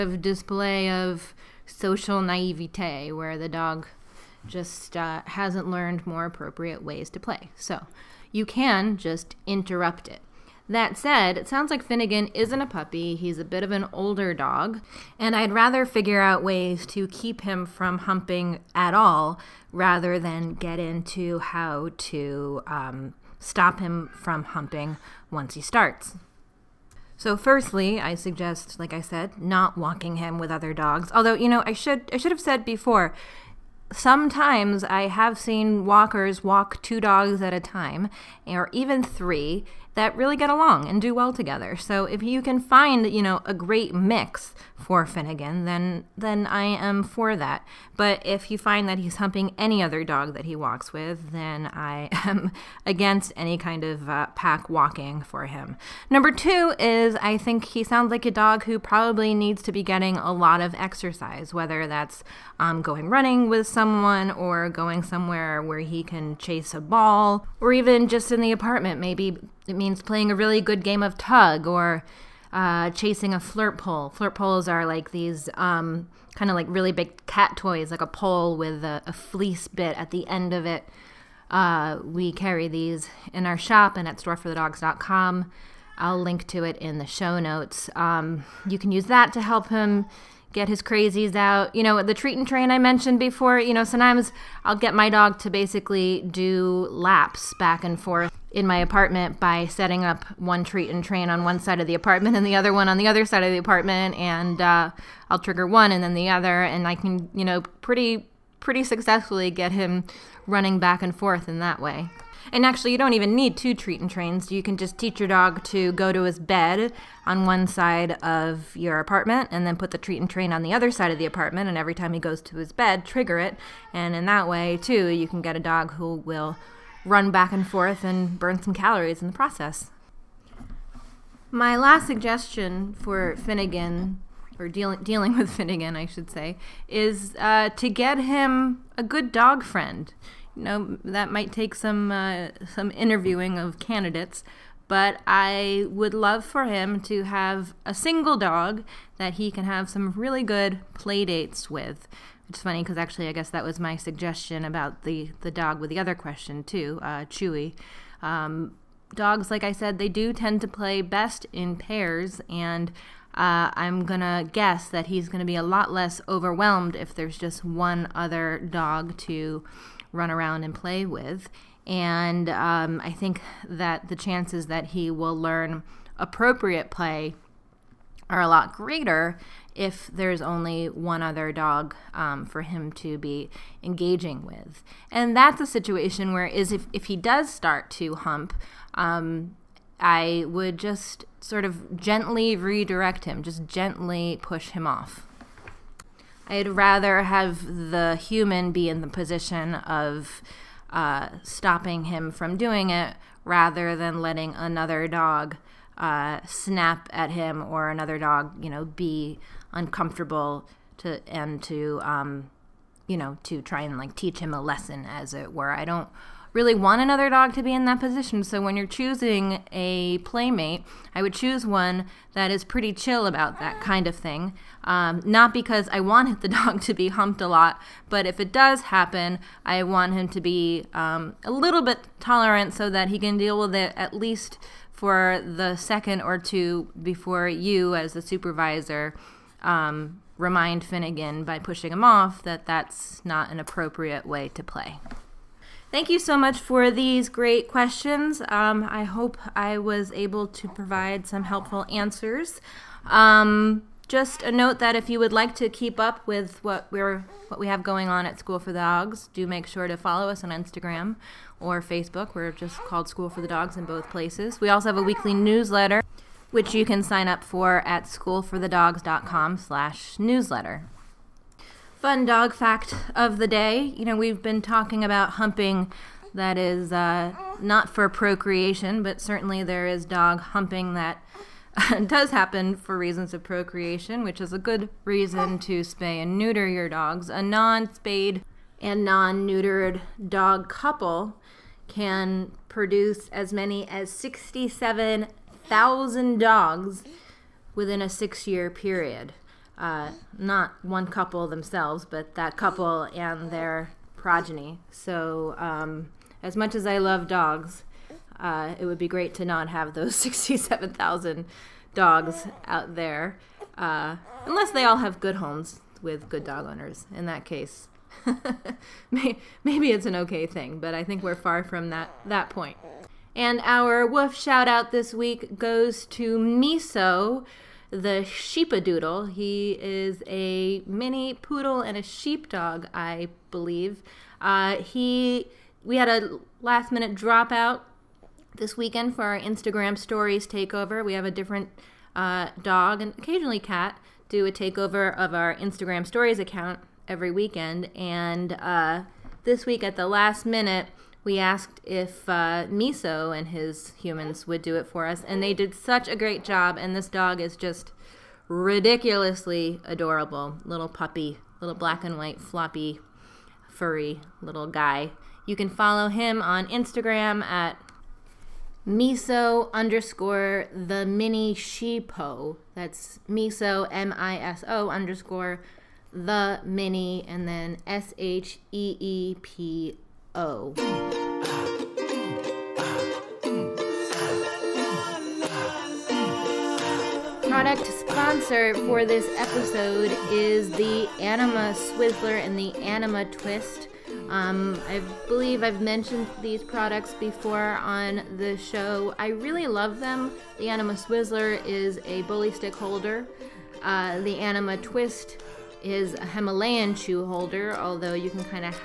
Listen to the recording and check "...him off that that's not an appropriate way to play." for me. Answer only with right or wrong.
right.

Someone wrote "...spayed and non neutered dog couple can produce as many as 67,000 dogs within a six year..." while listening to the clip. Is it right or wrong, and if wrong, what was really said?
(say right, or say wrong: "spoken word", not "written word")
right.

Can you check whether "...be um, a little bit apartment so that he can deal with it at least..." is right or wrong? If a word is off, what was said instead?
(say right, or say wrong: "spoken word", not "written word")
wrong: "tolerant", not "apartment".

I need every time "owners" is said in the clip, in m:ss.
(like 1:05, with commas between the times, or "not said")
5:16.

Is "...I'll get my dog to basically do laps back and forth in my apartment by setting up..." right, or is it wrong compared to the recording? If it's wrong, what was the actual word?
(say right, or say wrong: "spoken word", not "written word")
right.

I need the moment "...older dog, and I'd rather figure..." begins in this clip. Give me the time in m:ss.
0:13.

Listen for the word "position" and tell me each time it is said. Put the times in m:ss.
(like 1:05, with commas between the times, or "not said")
3:19, 3:38.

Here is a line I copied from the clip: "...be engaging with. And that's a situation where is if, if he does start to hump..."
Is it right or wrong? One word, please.
right.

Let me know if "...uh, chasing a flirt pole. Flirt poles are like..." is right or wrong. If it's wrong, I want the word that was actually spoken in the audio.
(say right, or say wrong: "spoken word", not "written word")
right.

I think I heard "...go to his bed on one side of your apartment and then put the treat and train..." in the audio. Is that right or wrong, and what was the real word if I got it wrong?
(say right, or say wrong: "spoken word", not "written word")
right.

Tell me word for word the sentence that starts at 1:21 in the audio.
Uh, we carry these in our shop and at storeforthedogs.com.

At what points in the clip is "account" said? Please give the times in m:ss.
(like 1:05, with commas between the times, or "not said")
5:46.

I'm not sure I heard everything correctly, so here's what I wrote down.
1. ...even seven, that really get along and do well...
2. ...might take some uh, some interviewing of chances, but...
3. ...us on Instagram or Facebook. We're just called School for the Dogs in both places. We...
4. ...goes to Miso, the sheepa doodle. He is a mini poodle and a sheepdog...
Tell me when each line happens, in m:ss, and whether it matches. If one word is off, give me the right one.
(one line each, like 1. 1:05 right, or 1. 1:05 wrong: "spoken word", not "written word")
1. 0:38 wrong: "three", not "seven"
2. 2:21 wrong: "candidates", not "chances"
3. 4:20 right
4. 5:25 right.